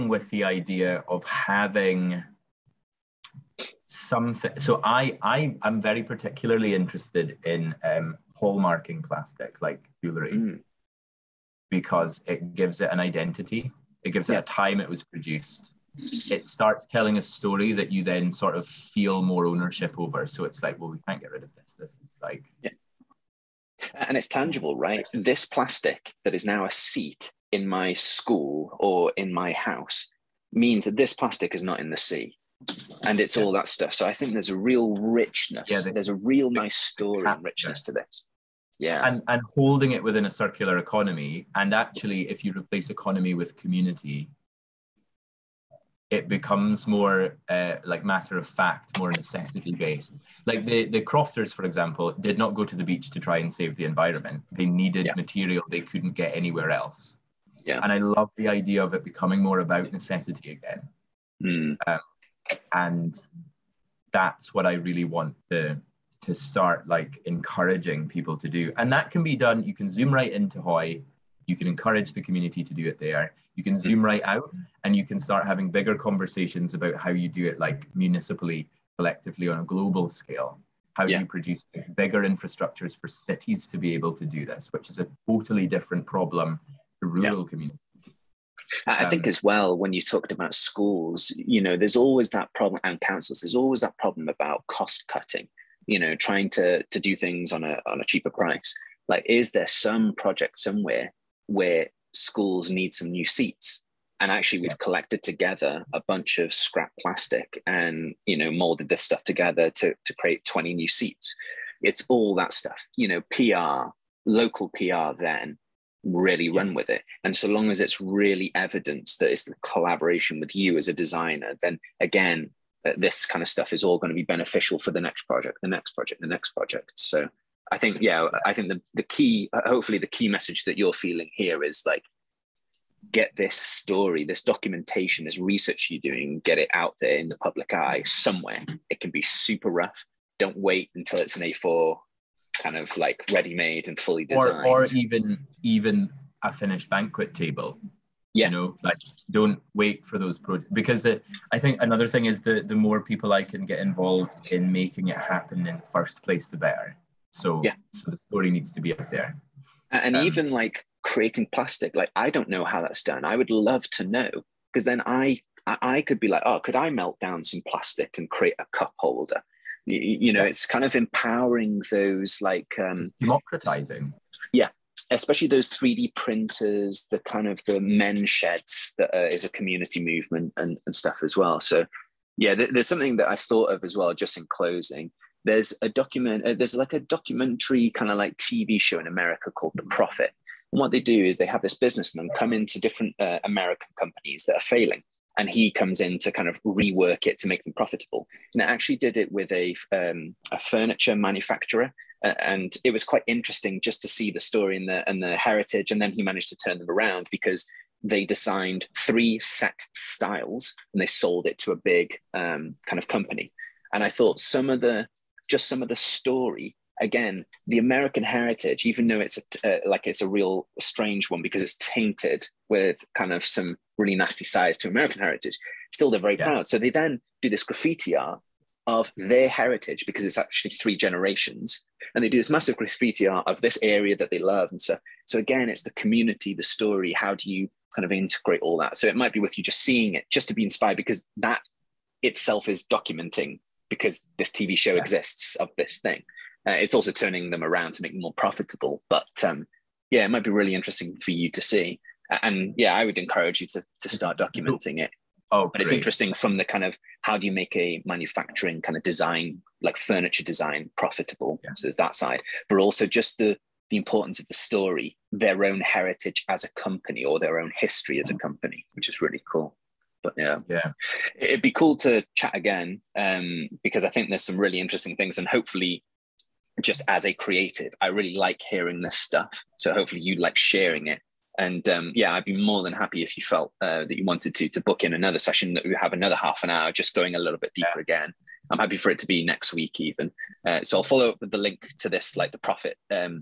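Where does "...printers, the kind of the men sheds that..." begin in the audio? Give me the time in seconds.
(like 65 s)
176 s.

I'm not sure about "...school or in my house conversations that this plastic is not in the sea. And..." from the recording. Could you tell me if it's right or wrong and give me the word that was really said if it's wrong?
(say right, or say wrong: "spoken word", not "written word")
wrong: "means", not "conversations".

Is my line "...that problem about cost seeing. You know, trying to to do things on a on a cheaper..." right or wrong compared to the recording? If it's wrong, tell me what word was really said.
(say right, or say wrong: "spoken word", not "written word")
wrong: "cutting", not "seeing".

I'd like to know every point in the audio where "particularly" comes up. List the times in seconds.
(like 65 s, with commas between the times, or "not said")
6 s.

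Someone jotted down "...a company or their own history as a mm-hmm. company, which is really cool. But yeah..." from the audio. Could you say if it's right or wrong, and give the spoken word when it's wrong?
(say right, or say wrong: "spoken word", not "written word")
right.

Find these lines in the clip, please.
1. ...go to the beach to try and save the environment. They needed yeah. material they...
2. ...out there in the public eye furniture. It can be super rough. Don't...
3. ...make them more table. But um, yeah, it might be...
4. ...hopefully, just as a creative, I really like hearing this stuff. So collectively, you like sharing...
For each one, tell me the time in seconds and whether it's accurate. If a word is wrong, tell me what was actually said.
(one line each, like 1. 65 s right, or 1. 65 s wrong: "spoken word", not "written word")
1. 52 s right
2. 136 s wrong: "somewhere", not "furniture"
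3. 248 s wrong: "profitable", not "table"
4. 275 s wrong: "hopefully", not "collectively".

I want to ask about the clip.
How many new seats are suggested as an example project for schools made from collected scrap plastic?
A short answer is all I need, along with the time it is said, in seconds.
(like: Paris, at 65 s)
20, at 110 s.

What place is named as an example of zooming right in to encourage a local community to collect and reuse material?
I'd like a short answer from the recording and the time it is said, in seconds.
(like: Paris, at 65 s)
Hoy, at 70 s.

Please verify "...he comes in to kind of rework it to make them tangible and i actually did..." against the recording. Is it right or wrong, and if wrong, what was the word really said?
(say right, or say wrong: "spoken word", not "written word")
wrong: "profitable", not "tangible".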